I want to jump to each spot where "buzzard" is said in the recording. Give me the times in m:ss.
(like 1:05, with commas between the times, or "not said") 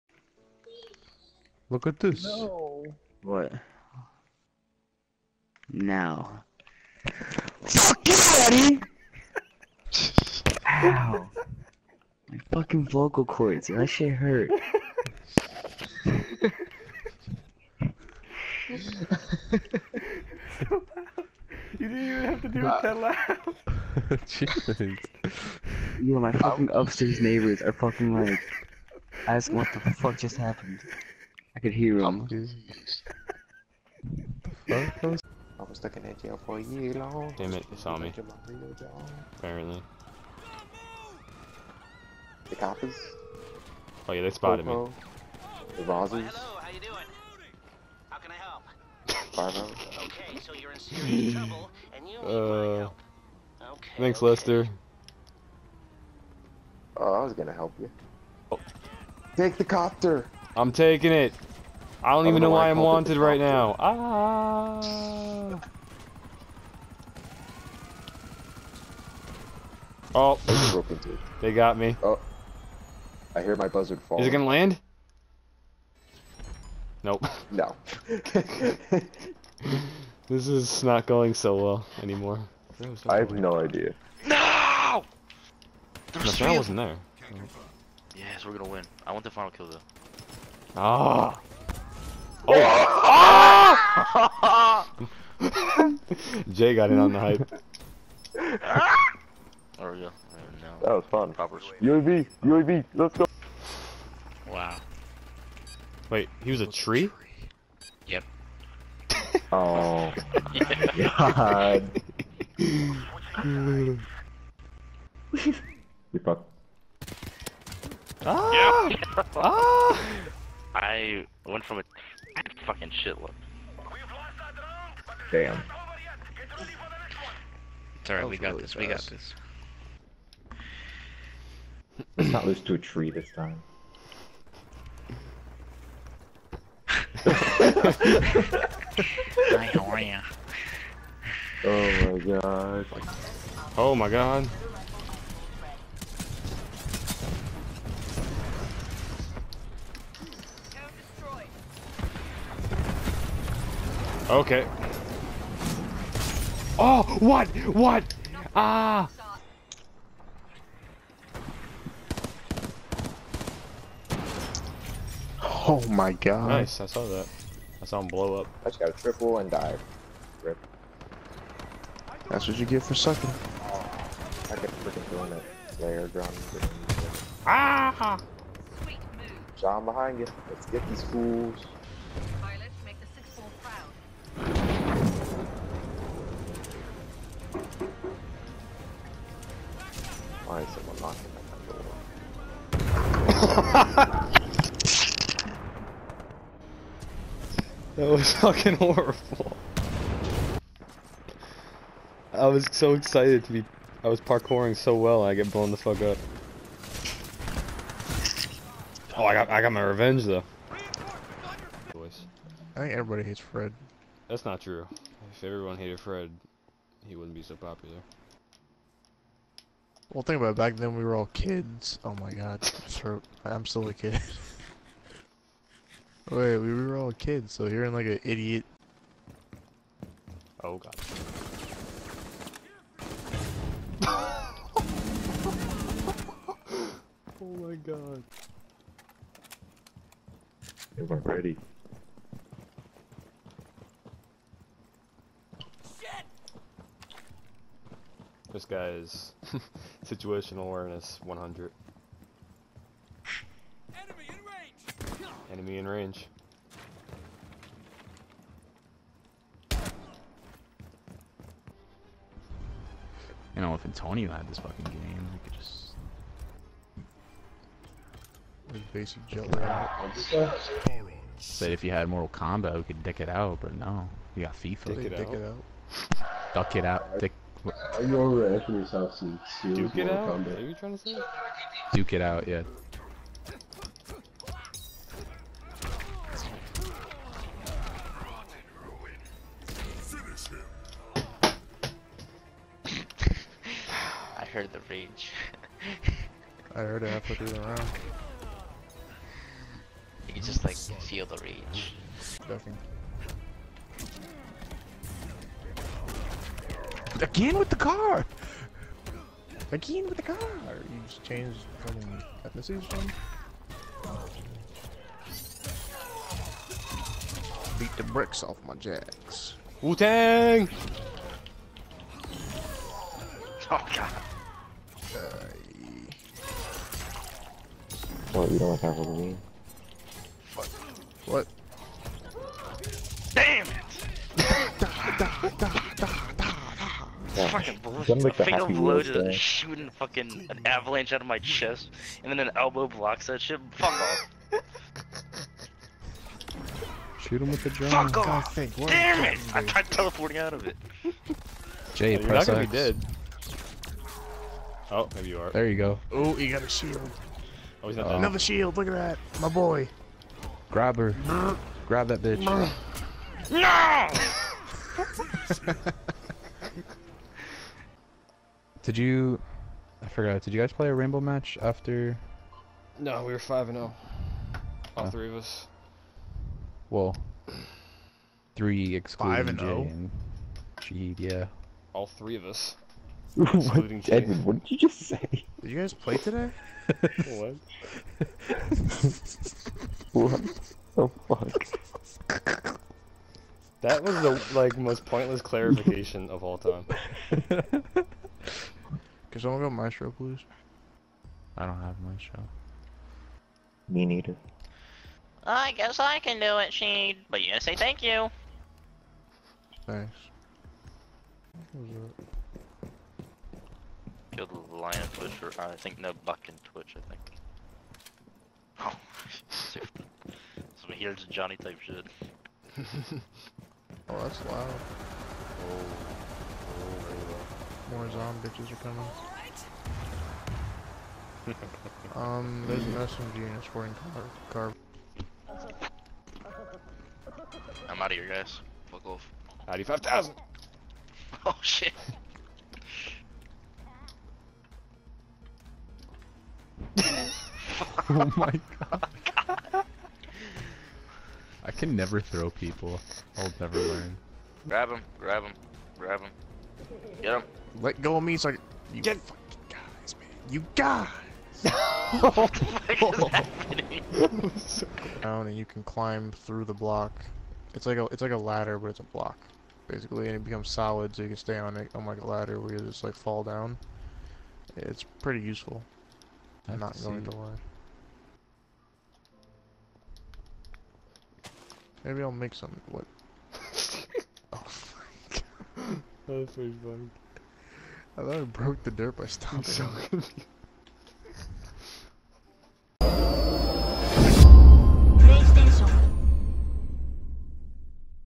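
1:13.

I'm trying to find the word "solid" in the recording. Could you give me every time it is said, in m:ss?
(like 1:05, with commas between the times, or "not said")
7:50.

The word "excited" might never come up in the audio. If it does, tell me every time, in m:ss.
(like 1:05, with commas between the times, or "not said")
3:22.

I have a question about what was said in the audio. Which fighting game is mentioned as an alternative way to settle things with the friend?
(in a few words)
Mortal Kombat.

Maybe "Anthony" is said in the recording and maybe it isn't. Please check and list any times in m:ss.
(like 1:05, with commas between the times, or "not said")
4:38.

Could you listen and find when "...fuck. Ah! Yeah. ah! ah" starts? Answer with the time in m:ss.
1:56.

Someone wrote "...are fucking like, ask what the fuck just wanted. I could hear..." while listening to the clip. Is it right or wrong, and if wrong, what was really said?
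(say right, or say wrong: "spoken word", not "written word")
wrong: "happened", not "wanted".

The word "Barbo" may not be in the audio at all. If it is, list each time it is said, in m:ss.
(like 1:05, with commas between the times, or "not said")
0:49.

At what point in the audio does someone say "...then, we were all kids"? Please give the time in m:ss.
3:40.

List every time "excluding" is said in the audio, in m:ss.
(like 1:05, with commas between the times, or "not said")
6:18, 6:23.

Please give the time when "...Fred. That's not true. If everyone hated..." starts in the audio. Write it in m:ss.
3:33.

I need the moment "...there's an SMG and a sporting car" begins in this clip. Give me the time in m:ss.
7:12.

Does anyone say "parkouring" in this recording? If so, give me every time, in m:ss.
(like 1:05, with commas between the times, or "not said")
3:24.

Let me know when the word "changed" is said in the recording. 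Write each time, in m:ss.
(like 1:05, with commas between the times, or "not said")
5:11.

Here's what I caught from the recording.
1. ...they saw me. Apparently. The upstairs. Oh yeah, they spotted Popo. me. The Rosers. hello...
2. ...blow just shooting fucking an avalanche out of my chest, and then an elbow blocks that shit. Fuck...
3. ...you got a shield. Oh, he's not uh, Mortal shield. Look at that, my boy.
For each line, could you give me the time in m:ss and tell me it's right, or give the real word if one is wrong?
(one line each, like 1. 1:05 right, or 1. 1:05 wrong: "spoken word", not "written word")
1. 0:37 wrong: "coppers", not "upstairs"
2. 5:38 right
3. 5:56 wrong: "Another", not "Mortal".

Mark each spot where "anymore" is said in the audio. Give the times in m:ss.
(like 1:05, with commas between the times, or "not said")
1:22.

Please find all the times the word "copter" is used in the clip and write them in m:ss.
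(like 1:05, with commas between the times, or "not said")
0:59.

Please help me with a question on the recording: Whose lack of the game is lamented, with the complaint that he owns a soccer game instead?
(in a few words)
Antonio.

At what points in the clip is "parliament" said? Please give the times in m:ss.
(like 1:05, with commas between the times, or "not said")
not said.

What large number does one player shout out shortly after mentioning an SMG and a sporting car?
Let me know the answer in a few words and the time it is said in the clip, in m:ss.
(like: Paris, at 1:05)
95,000, at 7:19.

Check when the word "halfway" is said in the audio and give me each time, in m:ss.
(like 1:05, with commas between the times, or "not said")
4:57.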